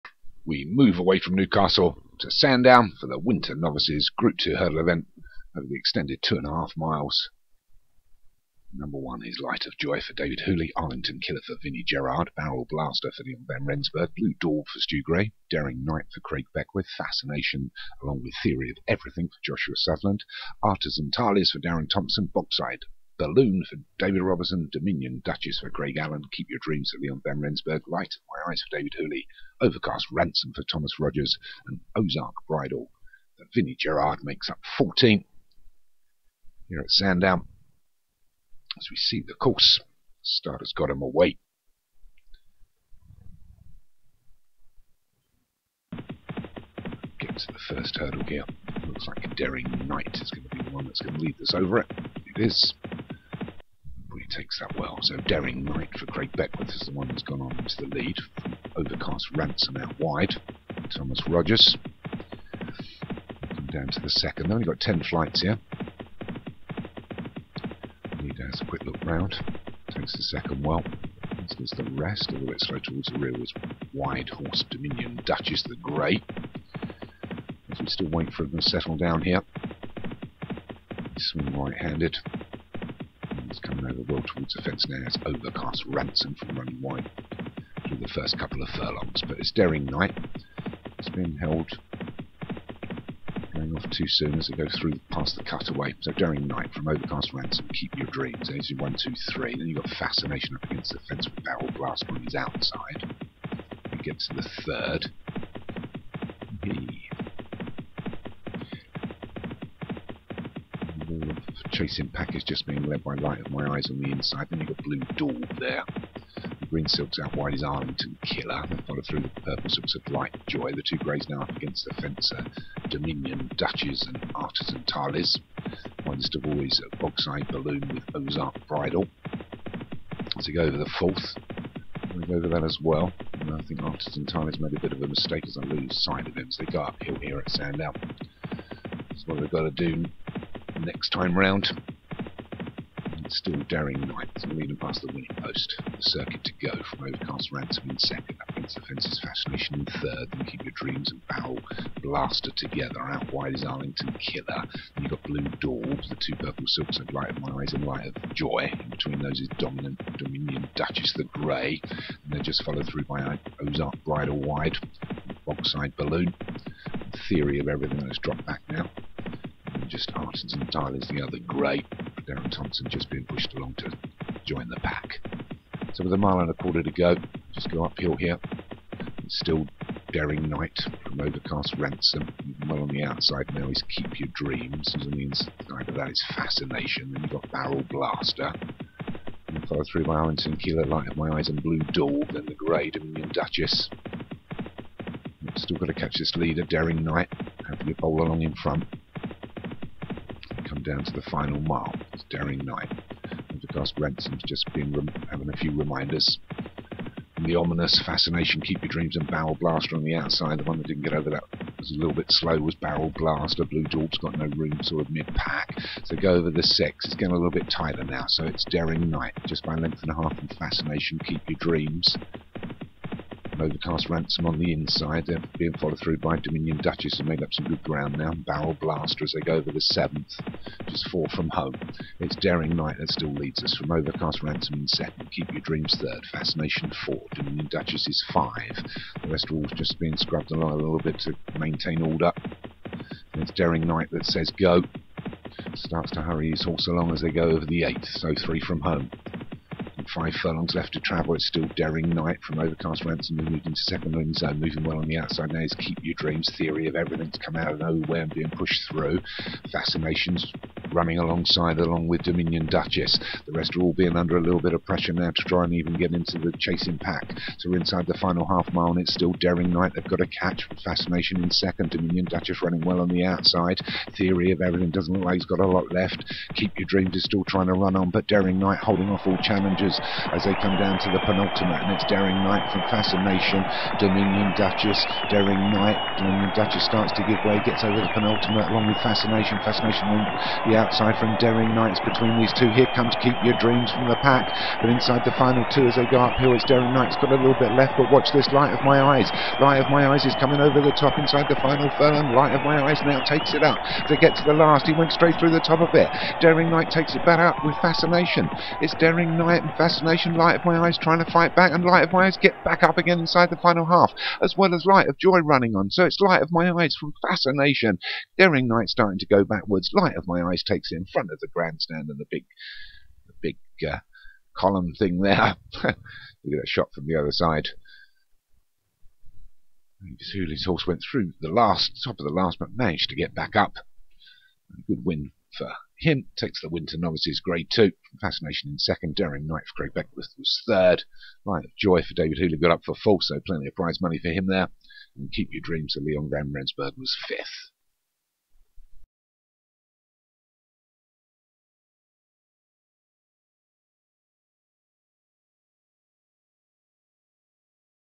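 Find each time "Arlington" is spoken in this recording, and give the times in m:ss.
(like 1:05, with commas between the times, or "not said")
0:10, 1:57, 2:33, 3:10.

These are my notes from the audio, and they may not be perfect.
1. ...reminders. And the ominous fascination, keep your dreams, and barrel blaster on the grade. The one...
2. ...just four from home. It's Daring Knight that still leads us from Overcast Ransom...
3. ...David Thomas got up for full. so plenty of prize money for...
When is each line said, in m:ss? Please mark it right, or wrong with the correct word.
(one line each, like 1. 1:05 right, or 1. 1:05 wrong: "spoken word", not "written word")
1. 3:25 wrong: "outside", not "grade"
2. 3:50 right
3. 5:42 wrong: "Hooley", not "Thomas".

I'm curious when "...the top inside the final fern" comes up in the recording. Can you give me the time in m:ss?
5:00.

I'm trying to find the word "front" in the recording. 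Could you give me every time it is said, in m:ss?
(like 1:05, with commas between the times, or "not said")
3:18, 5:21.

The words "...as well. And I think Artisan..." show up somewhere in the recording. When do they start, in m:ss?
2:12.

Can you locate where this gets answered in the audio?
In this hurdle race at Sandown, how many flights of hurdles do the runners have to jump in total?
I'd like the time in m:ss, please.
1:04.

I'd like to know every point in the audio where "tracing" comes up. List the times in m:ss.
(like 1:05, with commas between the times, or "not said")
1:51.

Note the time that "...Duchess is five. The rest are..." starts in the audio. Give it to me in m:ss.
3:57.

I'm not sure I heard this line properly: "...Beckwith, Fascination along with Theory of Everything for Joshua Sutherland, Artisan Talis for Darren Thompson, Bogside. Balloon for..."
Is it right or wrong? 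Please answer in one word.
right.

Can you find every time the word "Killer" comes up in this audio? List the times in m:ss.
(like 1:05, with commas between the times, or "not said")
0:11, 1:58, 2:34, 3:10.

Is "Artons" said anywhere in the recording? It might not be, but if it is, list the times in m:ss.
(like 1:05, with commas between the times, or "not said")
2:50.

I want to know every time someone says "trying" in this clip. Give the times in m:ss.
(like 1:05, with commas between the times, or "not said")
4:37, 5:10.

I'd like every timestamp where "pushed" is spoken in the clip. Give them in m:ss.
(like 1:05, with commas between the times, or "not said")
2:53, 4:18.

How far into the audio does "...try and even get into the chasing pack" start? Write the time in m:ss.
4:25.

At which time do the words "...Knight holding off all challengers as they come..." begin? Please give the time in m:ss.
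4:38.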